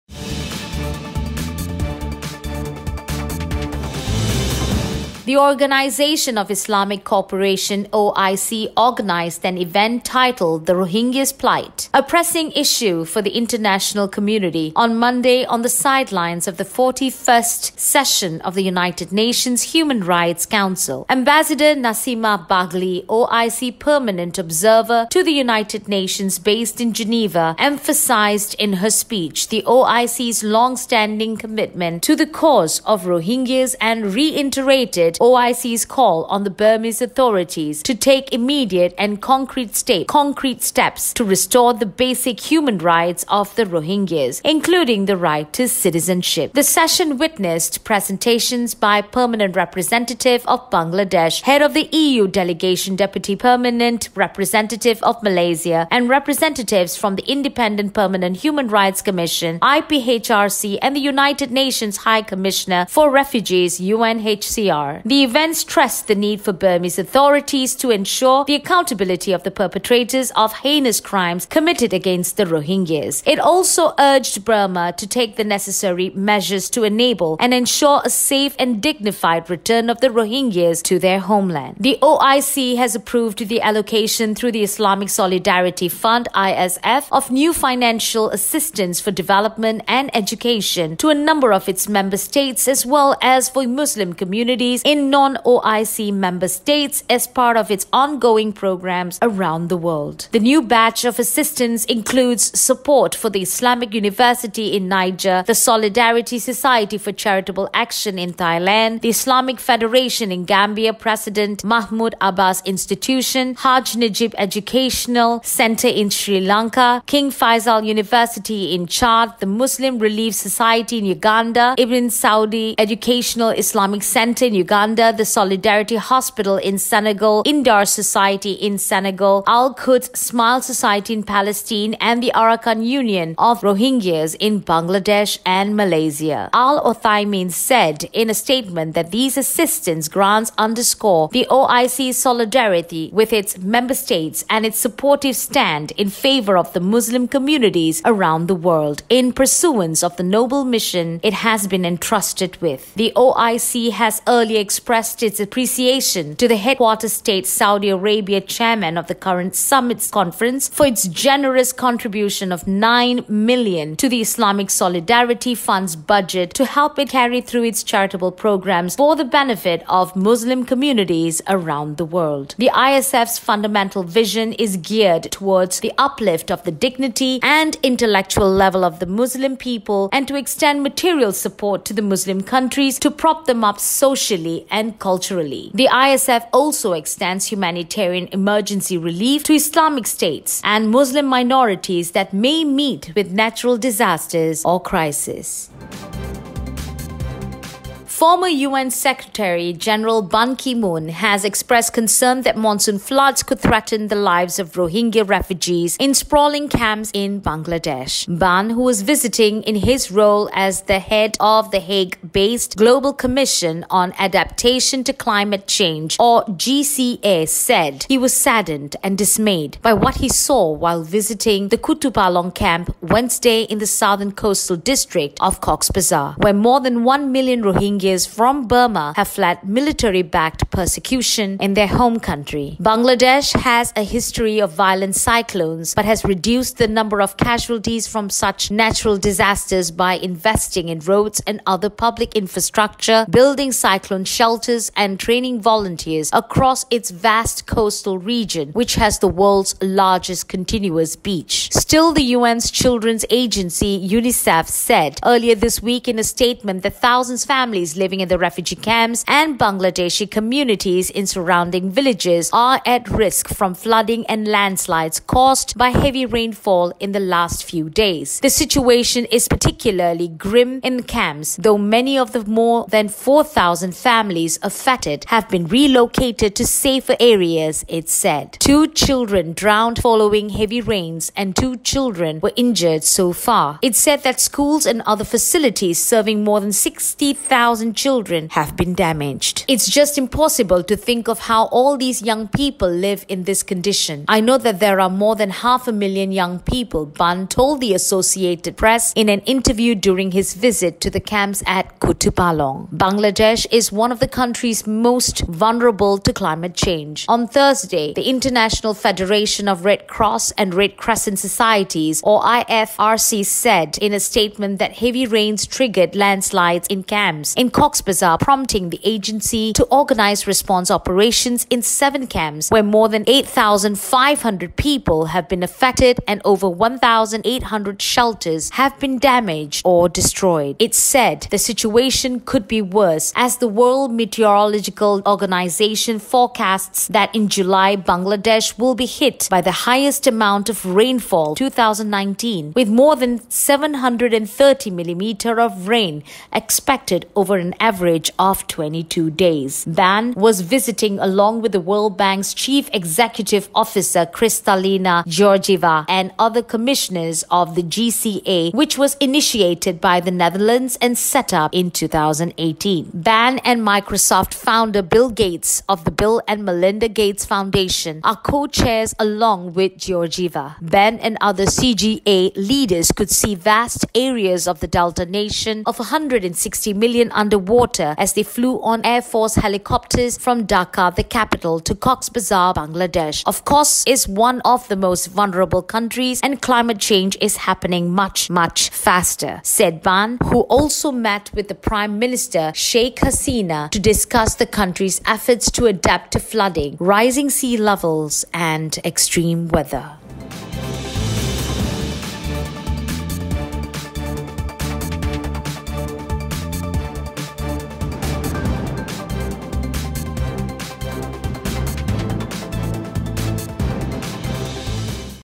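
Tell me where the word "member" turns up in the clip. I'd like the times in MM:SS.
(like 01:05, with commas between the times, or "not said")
01:31, 01:36, 02:23.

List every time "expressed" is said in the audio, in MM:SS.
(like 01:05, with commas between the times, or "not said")
02:34, 03:21.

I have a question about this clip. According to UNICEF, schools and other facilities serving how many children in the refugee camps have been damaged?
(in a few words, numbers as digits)
60,000.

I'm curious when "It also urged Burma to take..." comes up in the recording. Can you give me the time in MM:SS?
01:13.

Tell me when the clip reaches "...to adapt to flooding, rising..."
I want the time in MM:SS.
06:35.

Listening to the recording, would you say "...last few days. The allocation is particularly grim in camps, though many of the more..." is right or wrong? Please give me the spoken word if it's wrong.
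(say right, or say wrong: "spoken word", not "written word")
wrong: "situation", not "allocation".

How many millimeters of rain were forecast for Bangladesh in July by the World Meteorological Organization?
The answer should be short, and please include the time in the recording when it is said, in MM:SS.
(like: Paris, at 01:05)
730, at 05:43.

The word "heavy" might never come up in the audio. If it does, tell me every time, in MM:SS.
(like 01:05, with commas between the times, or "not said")
04:25, 04:40, 05:14.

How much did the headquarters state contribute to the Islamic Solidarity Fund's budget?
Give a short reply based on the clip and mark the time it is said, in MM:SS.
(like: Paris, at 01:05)
9 million, at 02:42.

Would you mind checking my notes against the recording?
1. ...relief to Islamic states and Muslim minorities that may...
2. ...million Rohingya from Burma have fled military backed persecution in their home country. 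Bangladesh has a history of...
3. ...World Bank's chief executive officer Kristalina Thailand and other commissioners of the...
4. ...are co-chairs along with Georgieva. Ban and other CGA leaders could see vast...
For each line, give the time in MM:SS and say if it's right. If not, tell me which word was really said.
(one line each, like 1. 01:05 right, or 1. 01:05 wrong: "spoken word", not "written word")
1. 03:08 right
2. 03:47 right
3. 05:51 wrong: "Georgieva", not "Thailand"
4. 06:08 right.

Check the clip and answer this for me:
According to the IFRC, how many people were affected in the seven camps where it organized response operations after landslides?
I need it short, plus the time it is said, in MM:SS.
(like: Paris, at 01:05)
8,500, at 05:23.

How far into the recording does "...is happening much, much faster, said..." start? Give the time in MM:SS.
06:27.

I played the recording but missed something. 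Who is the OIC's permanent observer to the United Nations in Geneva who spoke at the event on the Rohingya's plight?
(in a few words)
Nasima Baghli.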